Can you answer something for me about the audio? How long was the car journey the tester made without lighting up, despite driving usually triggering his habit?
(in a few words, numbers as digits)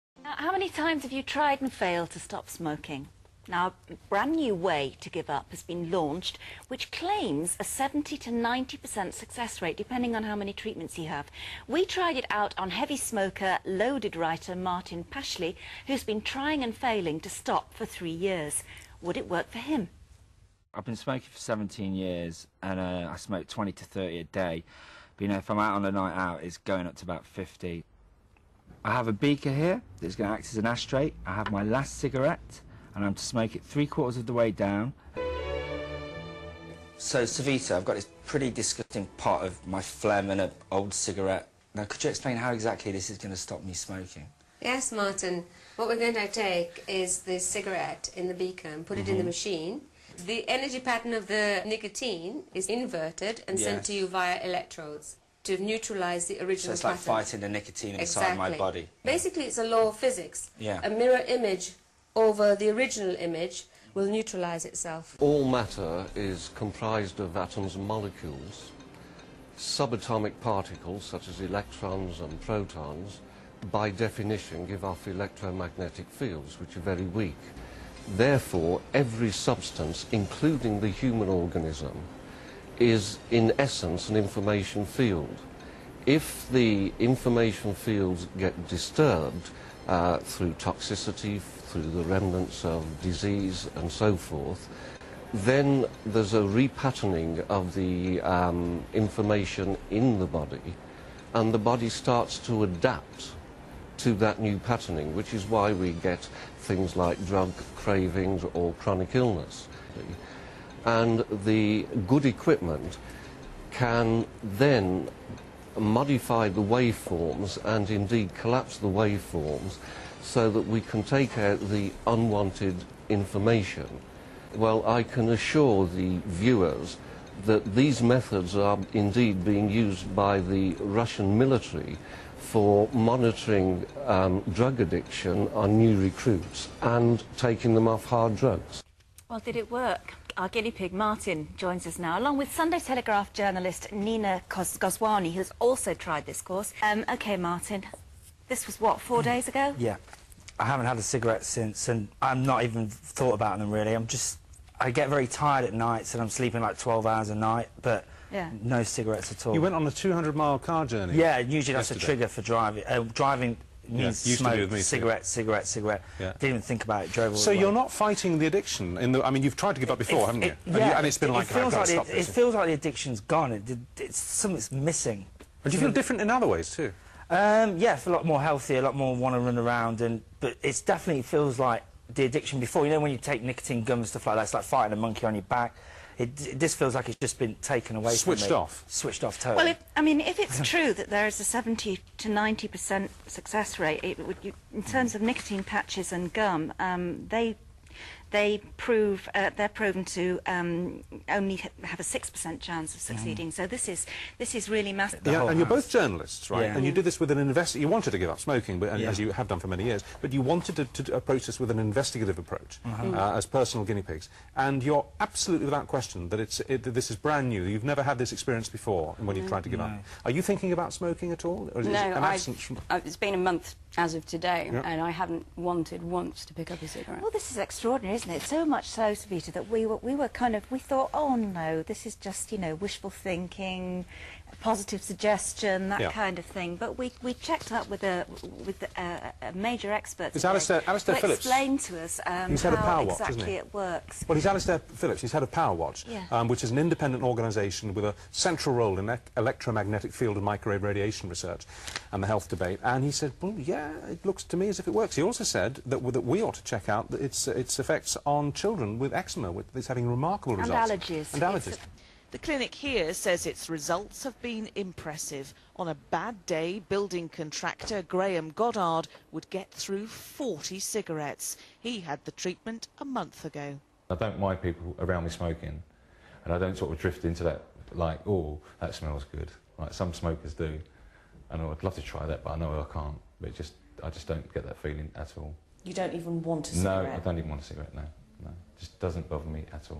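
200 miles.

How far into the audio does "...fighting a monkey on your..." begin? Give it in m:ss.
3:04.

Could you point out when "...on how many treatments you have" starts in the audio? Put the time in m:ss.
0:10.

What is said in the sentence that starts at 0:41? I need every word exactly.
Now, could you explain how exactly this is going to stop me smoking?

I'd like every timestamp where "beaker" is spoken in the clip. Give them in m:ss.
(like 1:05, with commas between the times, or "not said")
0:29, 0:48.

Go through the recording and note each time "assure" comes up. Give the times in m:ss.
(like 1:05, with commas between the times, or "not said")
2:05.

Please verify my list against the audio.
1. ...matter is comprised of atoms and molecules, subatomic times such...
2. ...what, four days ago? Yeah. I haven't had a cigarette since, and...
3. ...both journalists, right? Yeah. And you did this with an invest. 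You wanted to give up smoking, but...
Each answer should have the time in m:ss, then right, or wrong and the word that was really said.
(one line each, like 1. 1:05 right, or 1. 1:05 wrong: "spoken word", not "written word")
1. 1:05 wrong: "particles", not "times"
2. 2:28 right
3. 3:25 right.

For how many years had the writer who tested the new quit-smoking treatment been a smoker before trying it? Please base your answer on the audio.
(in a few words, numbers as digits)
17.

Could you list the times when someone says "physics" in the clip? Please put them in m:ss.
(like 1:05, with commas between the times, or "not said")
0:59.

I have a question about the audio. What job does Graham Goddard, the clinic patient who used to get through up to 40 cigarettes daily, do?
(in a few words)
Building contractor.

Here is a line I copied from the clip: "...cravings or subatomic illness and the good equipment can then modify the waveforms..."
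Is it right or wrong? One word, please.
wrong.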